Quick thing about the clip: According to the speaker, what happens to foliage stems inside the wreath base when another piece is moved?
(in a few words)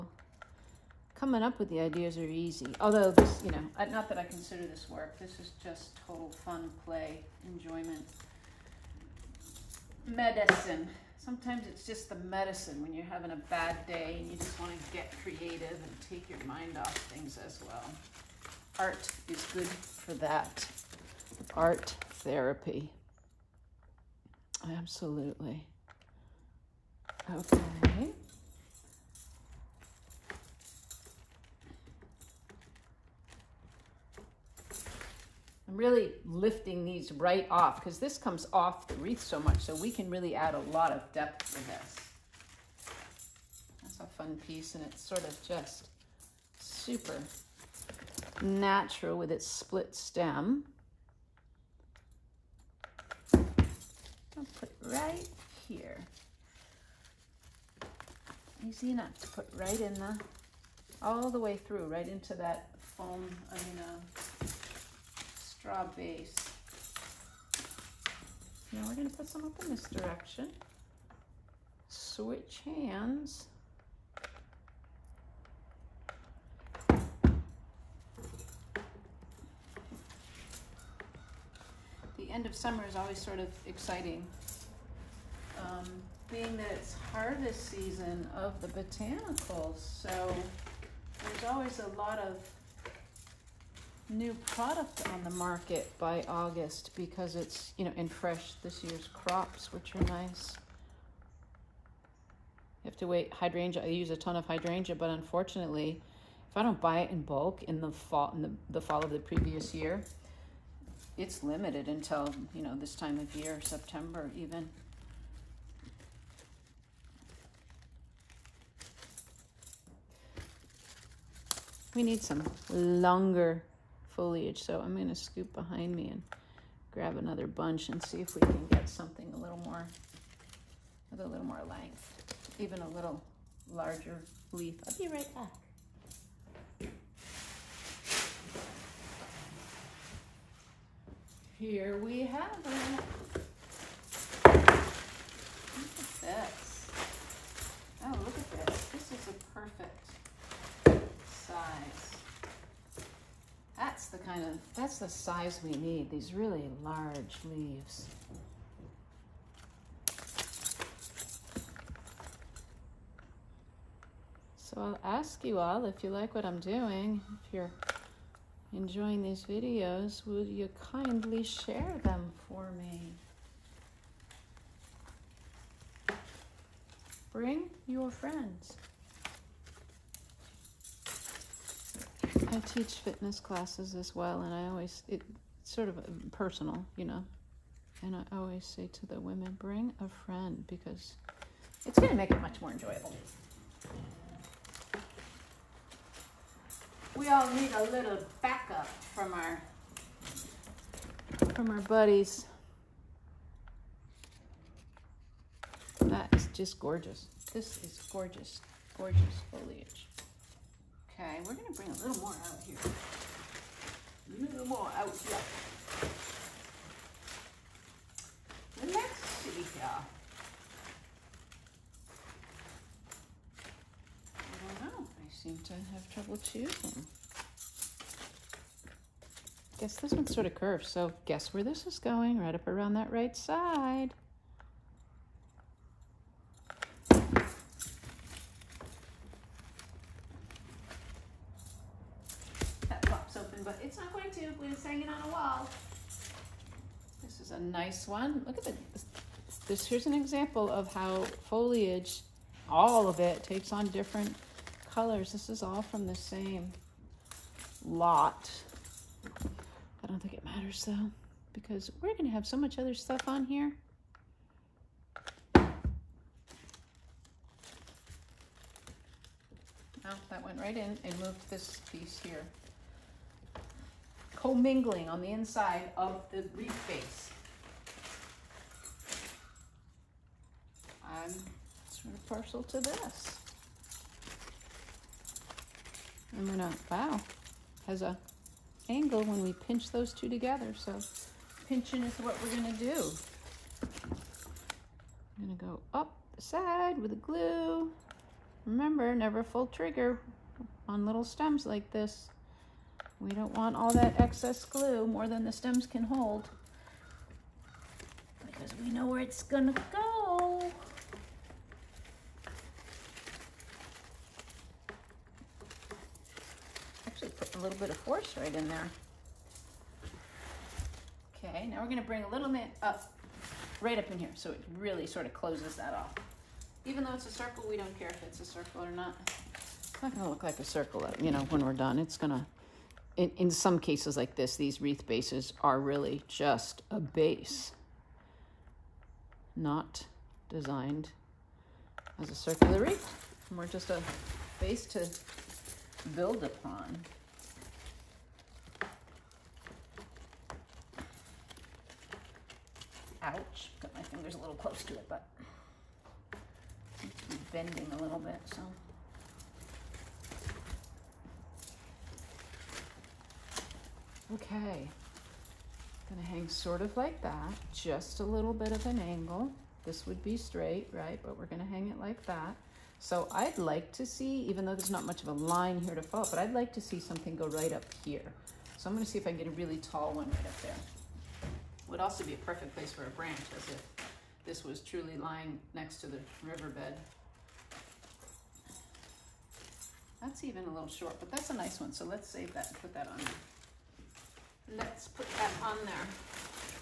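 Commingling.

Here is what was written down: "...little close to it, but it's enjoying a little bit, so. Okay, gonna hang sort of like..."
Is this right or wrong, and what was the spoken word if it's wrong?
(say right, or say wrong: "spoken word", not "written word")
wrong: "bending", not "enjoying".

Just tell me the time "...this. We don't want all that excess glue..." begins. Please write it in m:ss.
5:01.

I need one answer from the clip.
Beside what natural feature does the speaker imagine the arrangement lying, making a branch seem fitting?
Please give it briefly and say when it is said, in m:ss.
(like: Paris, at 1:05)
The riverbed, at 6:26.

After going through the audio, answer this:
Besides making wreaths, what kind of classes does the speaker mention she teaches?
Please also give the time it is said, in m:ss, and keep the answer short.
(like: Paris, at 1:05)
Fitness classes, at 3:02.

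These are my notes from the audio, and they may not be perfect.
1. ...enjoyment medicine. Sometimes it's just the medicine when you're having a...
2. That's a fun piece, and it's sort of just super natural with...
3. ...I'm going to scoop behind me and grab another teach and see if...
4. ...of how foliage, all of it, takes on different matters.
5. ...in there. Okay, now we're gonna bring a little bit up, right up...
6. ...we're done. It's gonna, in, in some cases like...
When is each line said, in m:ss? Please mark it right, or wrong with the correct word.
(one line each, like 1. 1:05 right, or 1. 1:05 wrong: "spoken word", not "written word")
1. 0:07 right
2. 0:43 right
3. 2:04 wrong: "bunch", not "teach"
4. 4:10 wrong: "colors", not "matters"
5. 5:18 right
6. 5:31 right.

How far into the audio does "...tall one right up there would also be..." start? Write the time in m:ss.
6:19.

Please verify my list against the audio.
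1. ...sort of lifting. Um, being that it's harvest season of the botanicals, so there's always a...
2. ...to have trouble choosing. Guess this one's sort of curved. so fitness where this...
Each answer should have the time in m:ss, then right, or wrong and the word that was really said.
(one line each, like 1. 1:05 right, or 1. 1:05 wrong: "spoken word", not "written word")
1. 1:23 wrong: "exciting", not "lifting"
2. 3:45 wrong: "guess", not "fitness".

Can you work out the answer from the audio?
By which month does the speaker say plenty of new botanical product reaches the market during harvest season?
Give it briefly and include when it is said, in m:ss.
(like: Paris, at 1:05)
August, at 1:35.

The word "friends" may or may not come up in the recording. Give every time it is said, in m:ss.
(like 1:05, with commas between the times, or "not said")
2:58, 3:10.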